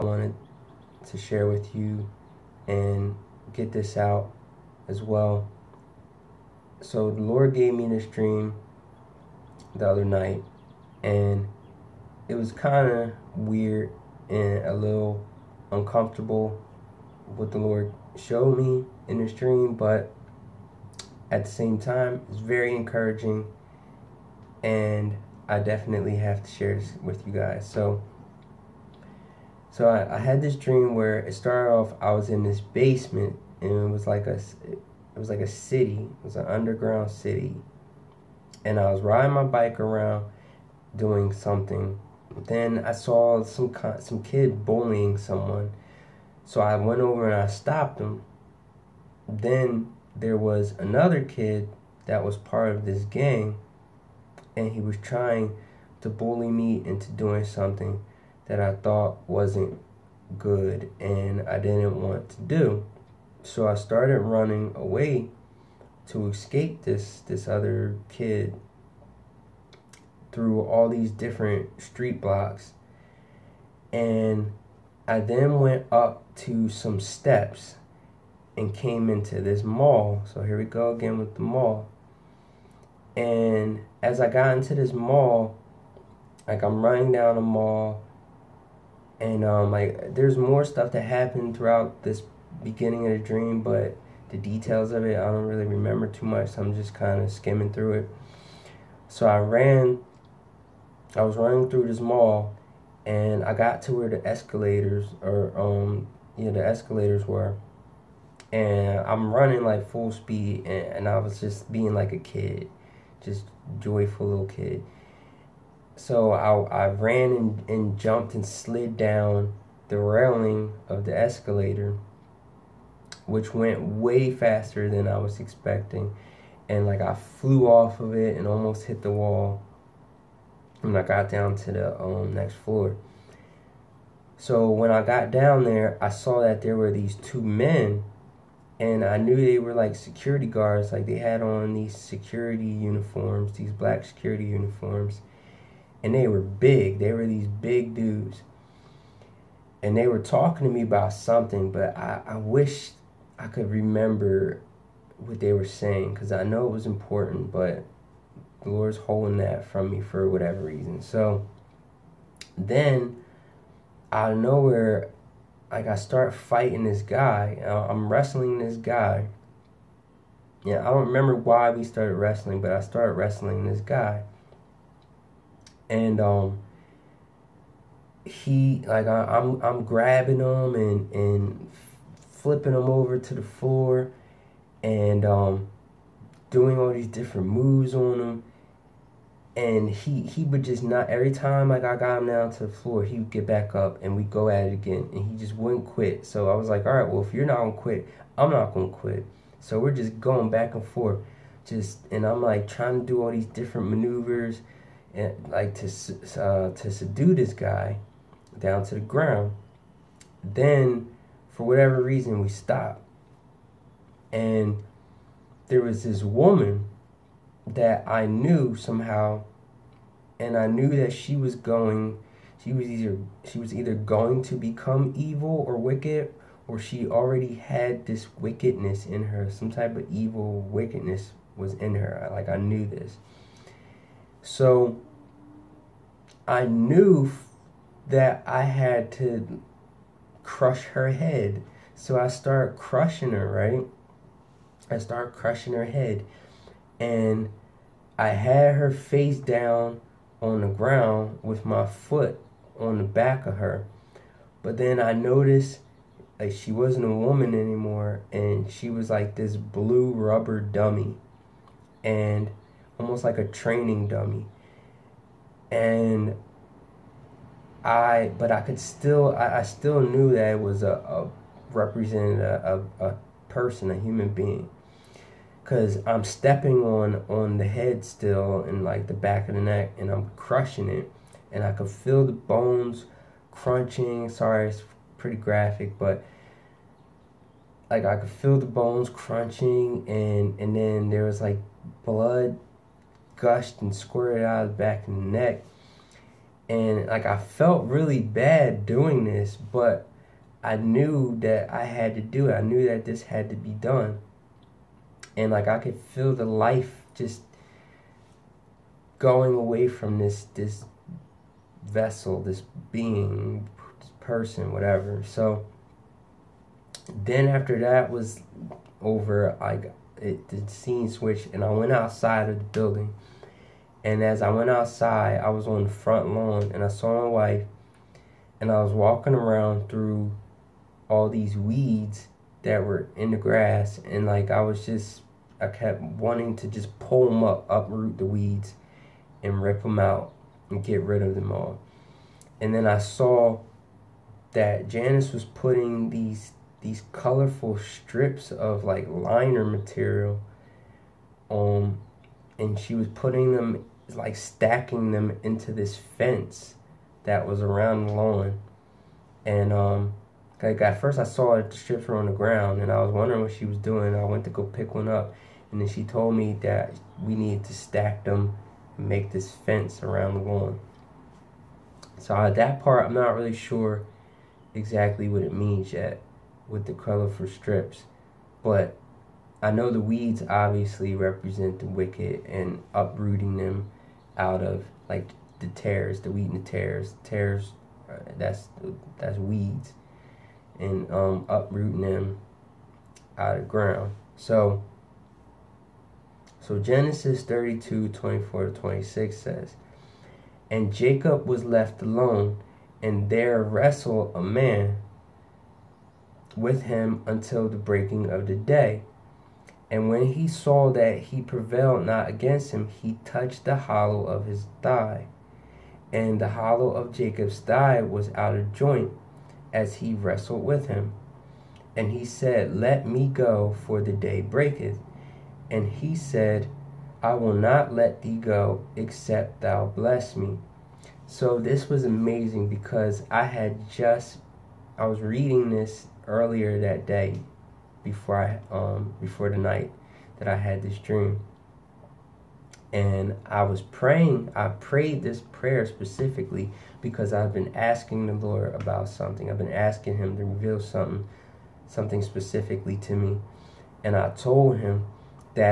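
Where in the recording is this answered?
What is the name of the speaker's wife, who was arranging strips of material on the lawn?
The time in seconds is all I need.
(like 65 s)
344 s.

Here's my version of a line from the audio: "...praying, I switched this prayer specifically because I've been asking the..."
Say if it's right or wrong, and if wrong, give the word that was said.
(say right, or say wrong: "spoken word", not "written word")
wrong: "prayed", not "switched".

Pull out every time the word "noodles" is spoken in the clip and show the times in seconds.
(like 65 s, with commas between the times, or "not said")
not said.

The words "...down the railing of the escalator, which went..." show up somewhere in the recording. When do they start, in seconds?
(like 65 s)
118 s.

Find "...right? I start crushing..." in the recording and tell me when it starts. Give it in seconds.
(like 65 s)
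243 s.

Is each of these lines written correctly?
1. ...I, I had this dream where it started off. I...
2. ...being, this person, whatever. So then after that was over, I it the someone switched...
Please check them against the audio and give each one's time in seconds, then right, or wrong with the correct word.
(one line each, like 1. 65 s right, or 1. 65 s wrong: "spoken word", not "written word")
1. 29 s right
2. 312 s wrong: "scene", not "someone".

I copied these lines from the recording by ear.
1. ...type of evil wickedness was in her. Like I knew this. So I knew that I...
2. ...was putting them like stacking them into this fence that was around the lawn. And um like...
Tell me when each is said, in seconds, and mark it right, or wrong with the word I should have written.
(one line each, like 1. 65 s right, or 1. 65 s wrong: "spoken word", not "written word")
1. 229 s right
2. 352 s right.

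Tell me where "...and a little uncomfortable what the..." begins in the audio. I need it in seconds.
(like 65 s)
14 s.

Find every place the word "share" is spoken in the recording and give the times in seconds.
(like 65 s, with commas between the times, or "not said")
1 s, 26 s.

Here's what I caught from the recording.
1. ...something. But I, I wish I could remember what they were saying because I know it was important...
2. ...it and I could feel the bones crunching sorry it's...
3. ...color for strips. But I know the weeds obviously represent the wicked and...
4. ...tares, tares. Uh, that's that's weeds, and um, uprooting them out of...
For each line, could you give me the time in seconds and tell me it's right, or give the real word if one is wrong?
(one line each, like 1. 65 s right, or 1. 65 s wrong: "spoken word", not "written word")
1. 151 s right
2. 280 s right
3. 376 s right
4. 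386 s right.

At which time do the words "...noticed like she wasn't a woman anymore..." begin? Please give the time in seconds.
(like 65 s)
255 s.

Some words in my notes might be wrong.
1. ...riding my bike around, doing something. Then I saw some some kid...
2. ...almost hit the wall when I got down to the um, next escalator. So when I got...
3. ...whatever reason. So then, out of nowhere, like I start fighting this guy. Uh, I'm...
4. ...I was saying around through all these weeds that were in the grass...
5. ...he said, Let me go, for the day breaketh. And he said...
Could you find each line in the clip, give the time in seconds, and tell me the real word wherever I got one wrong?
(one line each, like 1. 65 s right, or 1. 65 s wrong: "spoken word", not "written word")
1. 39 s right
2. 128 s wrong: "floor", not "escalator"
3. 160 s right
4. 328 s wrong: "walking", not "saying"
5. 422 s right.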